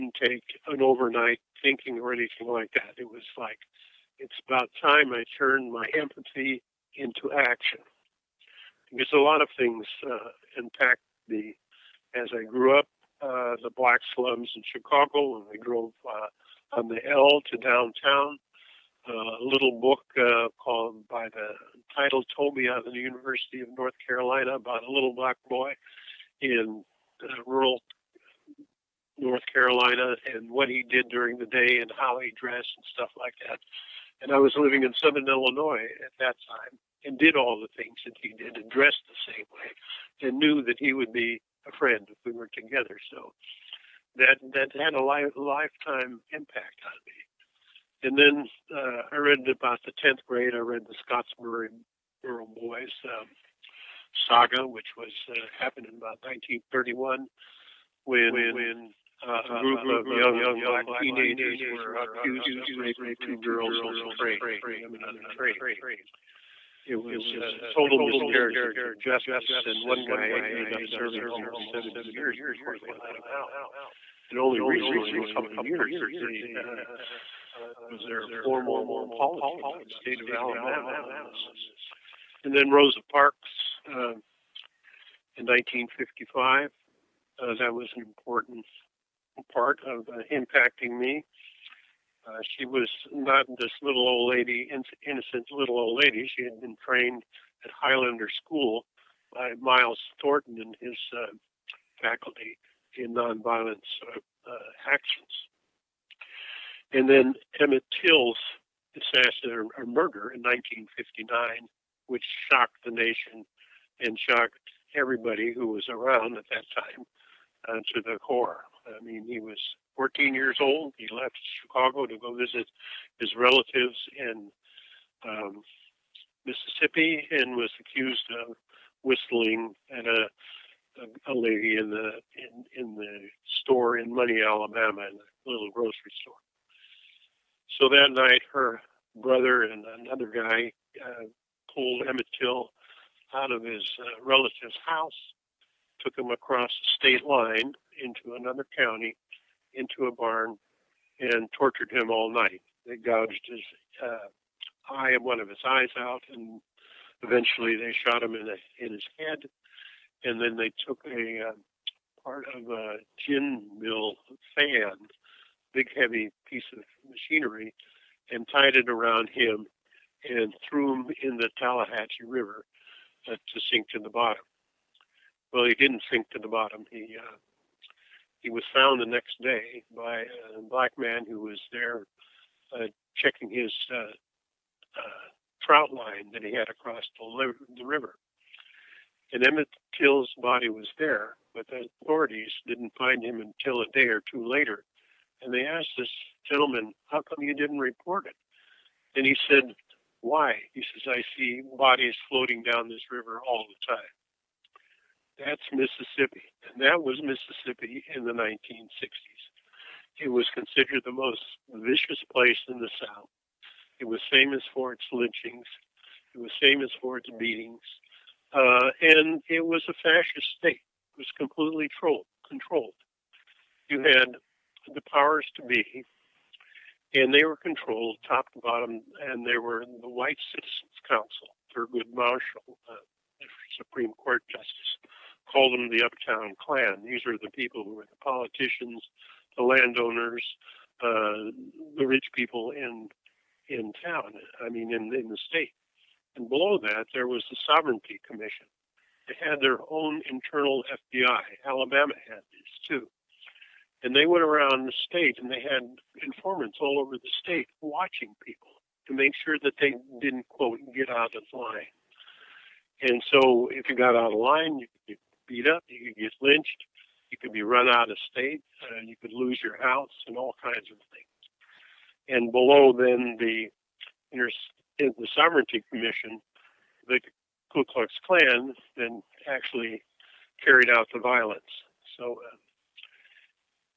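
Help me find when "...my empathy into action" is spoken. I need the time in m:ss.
0:05.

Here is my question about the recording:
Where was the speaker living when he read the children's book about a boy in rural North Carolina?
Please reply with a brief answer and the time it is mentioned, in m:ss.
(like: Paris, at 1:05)
Southern Illinois, at 0:35.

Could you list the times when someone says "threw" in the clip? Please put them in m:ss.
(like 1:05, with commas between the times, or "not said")
2:50.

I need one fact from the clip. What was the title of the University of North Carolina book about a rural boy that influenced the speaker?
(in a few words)
Toby.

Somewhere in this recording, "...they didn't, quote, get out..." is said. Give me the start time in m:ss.
4:19.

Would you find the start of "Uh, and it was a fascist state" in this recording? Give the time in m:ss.
3:38.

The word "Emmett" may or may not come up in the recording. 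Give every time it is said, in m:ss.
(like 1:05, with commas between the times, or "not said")
1:47, 2:22, 3:09.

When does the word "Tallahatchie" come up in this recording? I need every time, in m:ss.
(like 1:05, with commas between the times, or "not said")
2:51.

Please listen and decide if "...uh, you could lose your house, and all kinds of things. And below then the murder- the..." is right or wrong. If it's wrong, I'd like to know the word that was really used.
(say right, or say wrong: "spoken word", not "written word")
wrong: "inter", not "murder".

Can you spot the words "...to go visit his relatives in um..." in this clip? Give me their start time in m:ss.
2:02.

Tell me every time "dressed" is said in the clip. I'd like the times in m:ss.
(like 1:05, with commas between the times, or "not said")
0:32, 0:38.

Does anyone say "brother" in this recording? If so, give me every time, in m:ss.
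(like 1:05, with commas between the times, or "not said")
2:19.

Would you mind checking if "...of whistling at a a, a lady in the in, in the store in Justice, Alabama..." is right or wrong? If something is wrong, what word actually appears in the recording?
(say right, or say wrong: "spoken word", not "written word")
wrong: "Money", not "Justice".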